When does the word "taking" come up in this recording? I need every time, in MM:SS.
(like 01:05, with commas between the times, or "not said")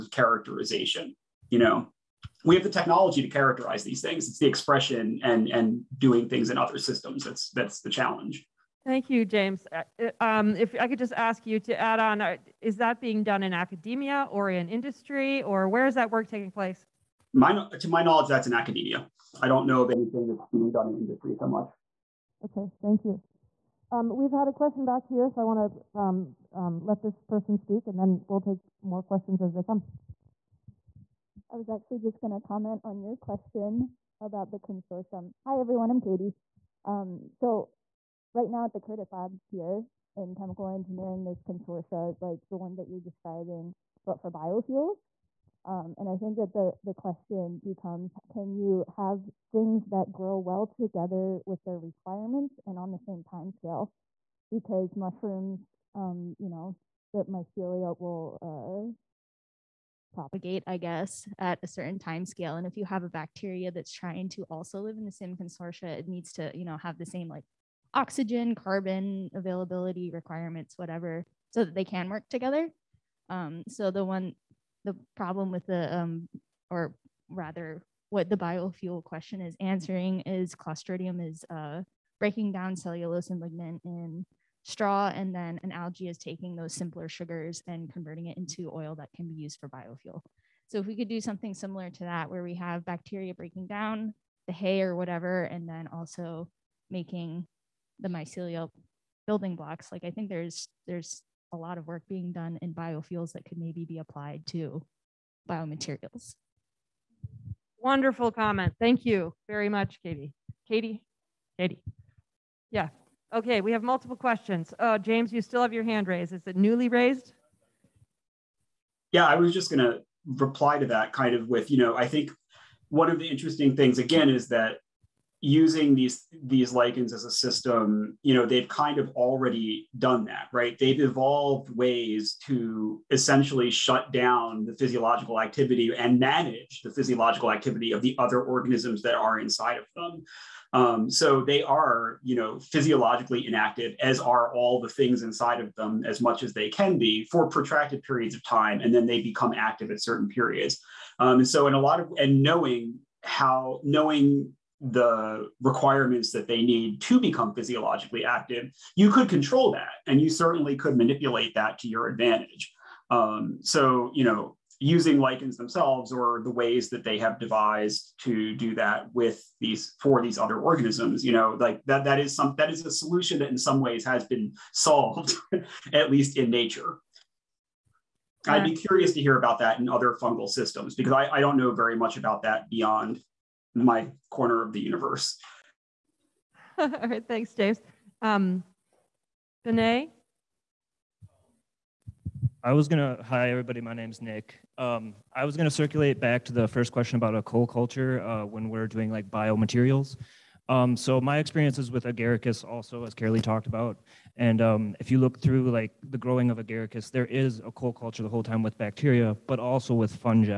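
00:16, 01:26.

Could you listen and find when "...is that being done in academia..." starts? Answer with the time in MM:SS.
00:12.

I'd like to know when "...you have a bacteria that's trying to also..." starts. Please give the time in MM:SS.
01:02.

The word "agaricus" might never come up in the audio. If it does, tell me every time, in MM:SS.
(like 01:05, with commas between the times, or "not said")
03:22, 03:26.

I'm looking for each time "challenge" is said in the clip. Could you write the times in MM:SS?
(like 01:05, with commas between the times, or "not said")
00:07.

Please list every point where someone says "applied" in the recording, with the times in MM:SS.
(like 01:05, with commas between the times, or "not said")
01:43.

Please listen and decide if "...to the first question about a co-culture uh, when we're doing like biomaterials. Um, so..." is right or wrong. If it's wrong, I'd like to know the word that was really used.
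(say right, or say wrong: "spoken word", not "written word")
right.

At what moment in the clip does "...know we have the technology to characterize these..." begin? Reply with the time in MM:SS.
00:01.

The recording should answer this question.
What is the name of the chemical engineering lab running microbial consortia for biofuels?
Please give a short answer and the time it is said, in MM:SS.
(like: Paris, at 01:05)
Curtis Lab, at 00:38.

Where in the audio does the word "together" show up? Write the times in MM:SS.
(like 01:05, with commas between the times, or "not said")
00:50, 01:12.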